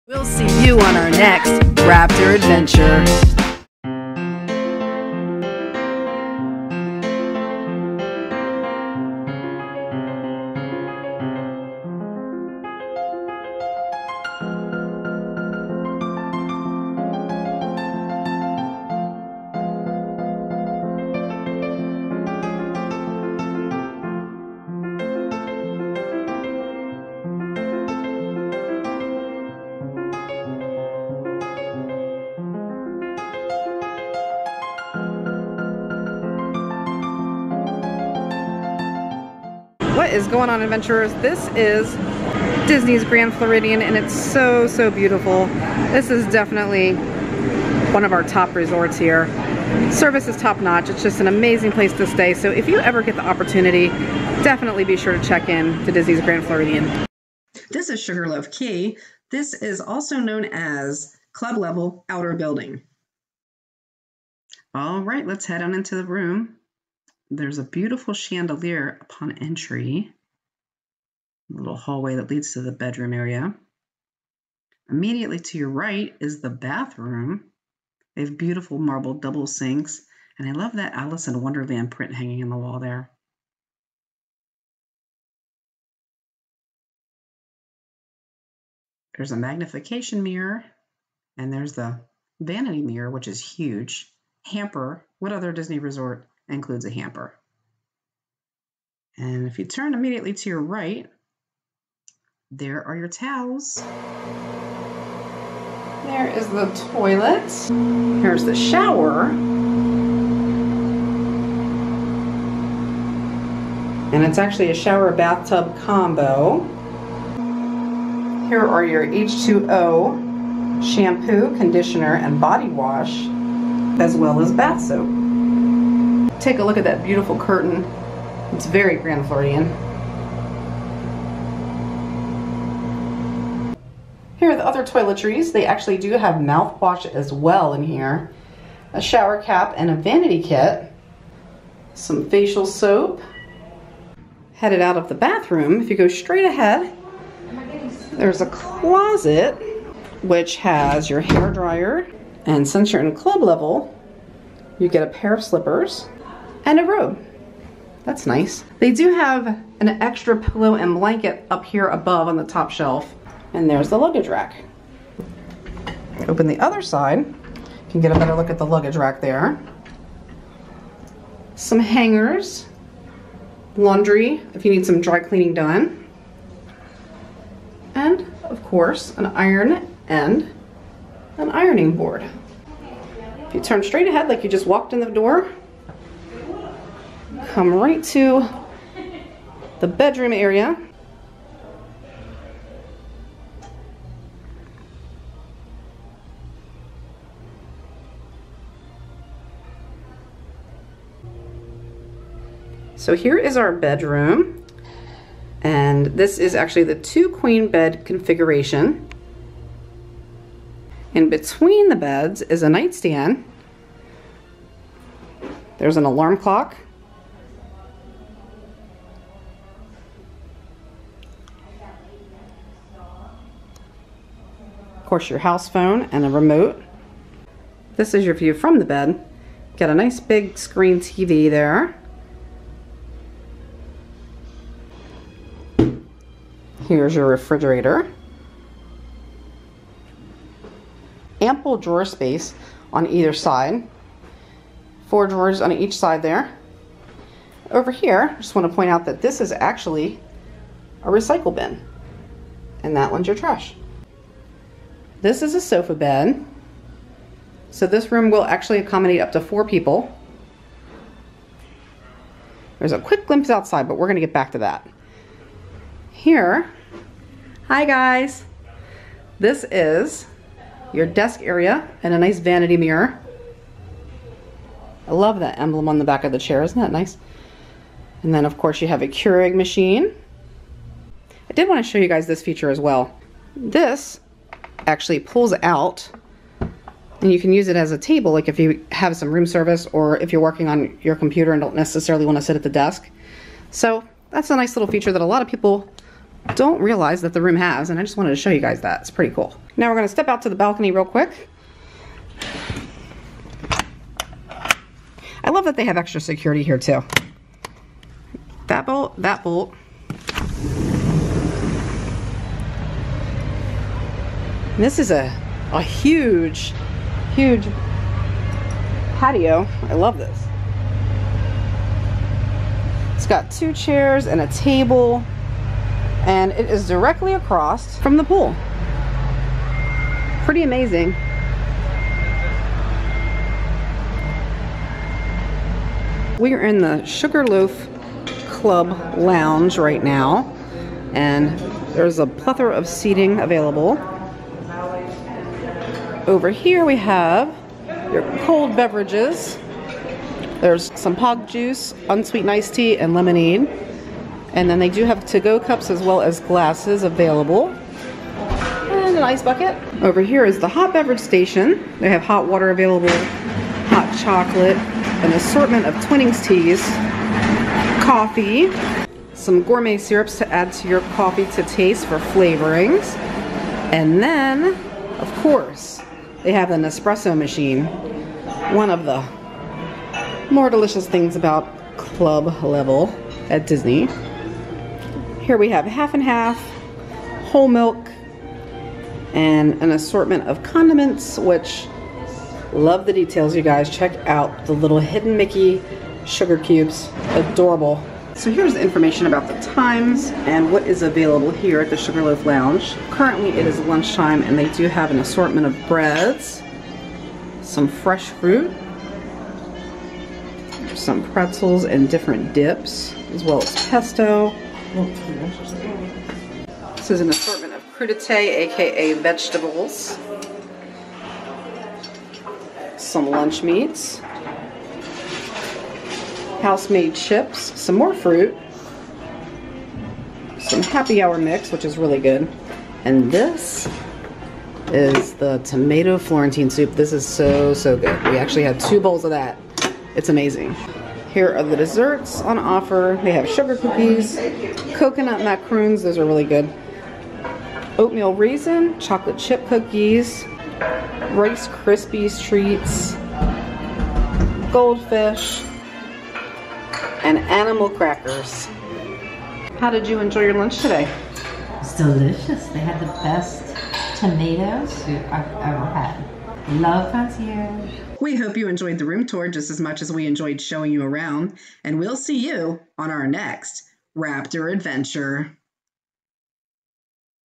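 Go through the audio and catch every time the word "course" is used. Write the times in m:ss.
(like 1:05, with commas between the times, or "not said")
2:58, 3:45, 4:38, 6:15.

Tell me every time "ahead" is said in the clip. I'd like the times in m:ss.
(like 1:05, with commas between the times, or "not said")
2:26, 3:04.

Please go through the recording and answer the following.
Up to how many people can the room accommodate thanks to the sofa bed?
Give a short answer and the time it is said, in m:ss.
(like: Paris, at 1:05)
4, at 4:19.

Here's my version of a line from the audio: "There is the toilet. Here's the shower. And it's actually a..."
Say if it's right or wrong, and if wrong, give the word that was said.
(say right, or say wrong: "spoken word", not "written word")
right.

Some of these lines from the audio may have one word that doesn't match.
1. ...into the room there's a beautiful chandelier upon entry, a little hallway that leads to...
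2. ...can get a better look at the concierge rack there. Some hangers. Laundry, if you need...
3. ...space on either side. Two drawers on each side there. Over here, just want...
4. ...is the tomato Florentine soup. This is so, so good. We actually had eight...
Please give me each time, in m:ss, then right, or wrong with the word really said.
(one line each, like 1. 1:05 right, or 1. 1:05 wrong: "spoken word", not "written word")
1. 1:05 right
2. 2:47 wrong: "luggage", not "concierge"
3. 4:02 wrong: "Four", not "Two"
4. 7:14 wrong: "two", not "eight".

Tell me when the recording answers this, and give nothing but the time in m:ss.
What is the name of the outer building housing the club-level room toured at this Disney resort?
0:58.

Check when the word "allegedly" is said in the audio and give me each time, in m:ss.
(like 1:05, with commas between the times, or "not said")
not said.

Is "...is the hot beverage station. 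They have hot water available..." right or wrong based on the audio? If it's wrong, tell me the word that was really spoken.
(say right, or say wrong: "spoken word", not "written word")
right.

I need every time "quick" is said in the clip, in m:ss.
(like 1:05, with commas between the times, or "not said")
4:22, 5:01.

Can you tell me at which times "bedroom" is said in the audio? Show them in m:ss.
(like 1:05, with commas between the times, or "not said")
1:12, 3:09, 3:23.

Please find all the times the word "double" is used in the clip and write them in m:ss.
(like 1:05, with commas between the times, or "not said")
1:19.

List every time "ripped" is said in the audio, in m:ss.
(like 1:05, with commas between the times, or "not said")
not said.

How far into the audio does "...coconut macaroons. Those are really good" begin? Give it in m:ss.
7:24.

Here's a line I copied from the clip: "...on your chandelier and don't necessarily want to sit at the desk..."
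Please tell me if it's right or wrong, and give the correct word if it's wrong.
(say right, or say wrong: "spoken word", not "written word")
wrong: "computer", not "chandelier".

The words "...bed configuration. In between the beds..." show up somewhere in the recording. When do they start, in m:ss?
3:27.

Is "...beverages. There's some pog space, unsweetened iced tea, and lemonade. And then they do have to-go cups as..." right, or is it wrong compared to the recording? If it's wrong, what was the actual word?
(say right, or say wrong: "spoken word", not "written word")
wrong: "juice", not "space".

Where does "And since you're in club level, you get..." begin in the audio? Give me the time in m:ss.
2:32.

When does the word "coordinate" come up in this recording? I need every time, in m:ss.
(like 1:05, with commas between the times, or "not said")
not said.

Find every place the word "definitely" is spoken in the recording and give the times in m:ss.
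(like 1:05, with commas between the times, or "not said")
0:46, 0:54.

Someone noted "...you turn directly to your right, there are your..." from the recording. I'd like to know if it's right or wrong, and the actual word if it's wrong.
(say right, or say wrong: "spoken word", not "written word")
wrong: "immediately", not "directly".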